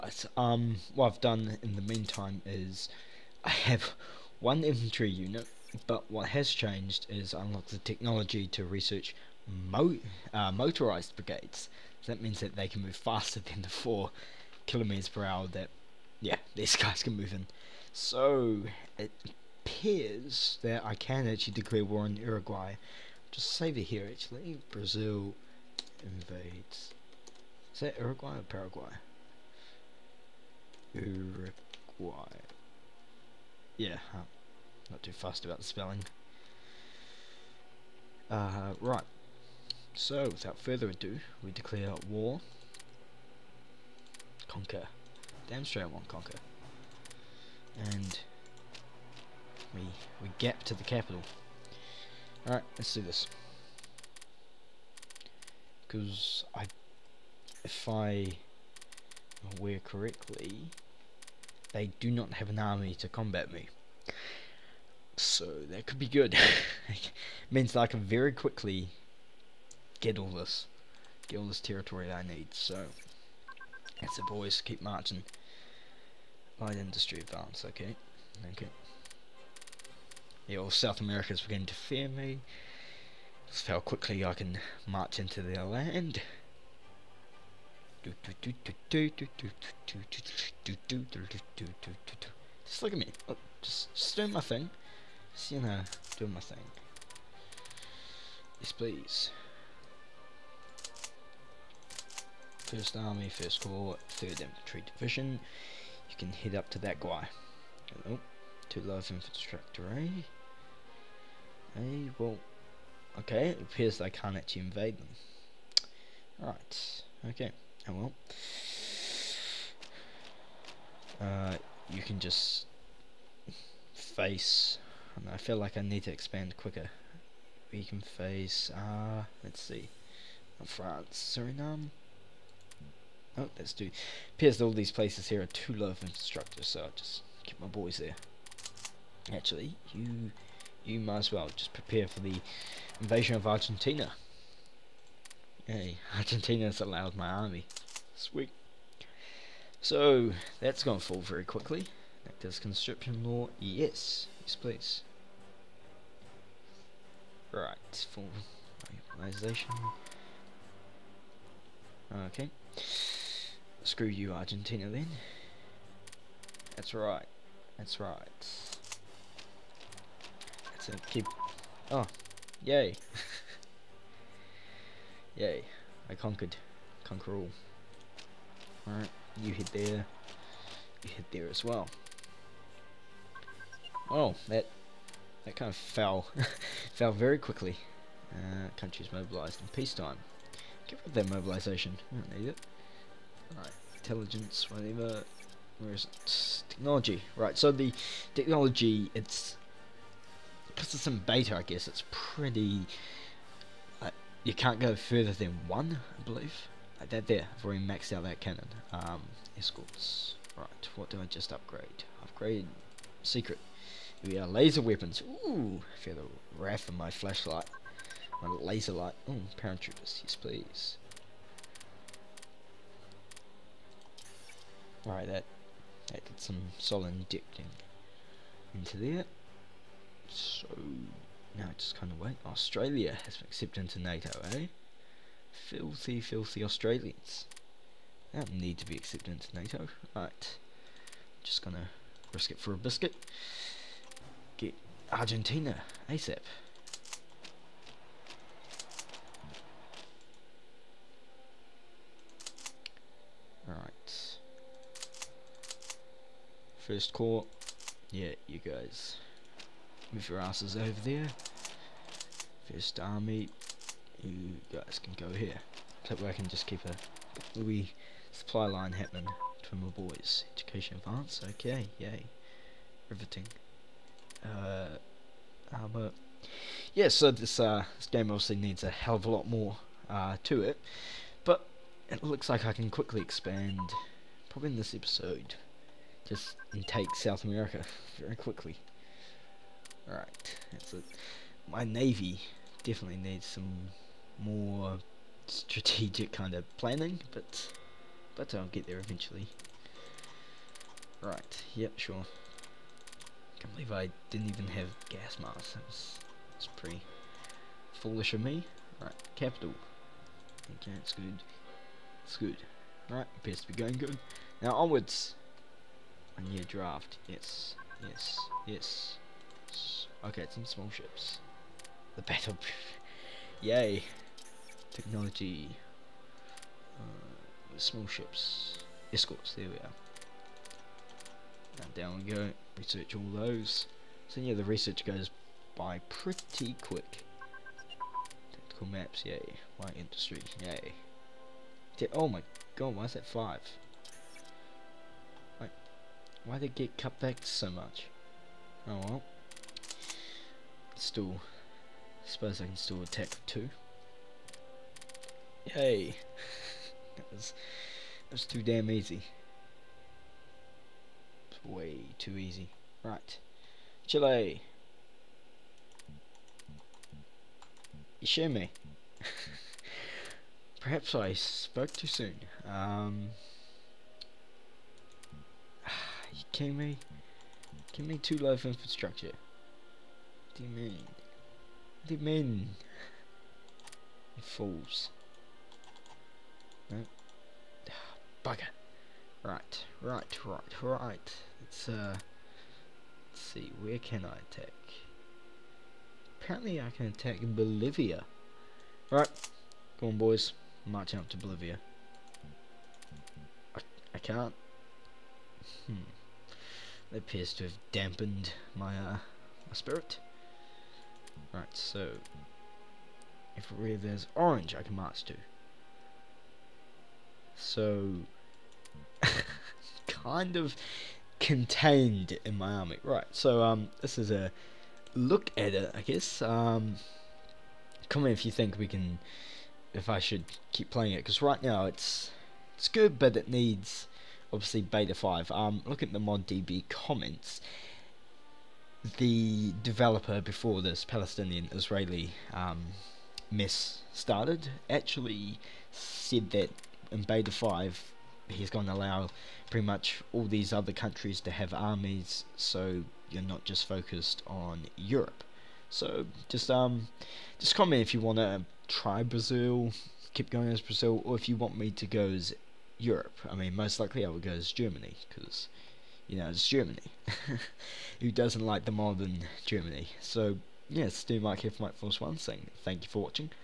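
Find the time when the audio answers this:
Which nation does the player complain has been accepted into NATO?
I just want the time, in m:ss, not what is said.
3:52.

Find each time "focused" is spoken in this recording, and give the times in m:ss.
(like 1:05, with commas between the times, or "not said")
7:33.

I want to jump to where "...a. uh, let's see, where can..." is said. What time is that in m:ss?
6:31.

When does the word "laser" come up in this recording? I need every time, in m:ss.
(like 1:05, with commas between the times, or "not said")
3:34, 3:38.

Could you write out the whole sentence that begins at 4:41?
But it looks like I can quickly expand, probably in this episode, just and take South America very quickly.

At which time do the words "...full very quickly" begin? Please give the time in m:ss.
2:30.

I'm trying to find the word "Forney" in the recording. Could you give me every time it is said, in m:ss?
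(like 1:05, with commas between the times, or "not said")
not said.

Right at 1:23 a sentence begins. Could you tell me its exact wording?
That's how quickly I can march into their land.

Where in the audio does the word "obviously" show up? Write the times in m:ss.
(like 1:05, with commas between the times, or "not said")
4:38, 7:14.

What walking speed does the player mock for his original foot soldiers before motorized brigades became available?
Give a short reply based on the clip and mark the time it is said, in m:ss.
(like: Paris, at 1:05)
4 kilometers per hour, at 0:13.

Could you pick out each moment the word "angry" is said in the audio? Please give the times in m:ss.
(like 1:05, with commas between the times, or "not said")
not said.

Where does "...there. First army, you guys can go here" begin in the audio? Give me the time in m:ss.
4:21.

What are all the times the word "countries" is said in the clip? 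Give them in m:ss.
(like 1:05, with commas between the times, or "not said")
3:08, 7:30.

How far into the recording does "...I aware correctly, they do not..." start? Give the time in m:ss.
0:57.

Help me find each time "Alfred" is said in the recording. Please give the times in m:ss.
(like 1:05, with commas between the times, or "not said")
not said.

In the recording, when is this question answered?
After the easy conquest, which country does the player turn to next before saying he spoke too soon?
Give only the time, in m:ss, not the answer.
6:04.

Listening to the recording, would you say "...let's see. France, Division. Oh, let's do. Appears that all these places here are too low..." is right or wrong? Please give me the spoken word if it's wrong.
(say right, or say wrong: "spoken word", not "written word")
wrong: "Suriname", not "Division".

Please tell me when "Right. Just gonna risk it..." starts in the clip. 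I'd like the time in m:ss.
4:00.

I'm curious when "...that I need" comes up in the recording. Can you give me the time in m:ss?
1:12.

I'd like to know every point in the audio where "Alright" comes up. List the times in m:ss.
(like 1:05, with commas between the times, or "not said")
0:52, 2:58, 3:13, 3:45, 4:13.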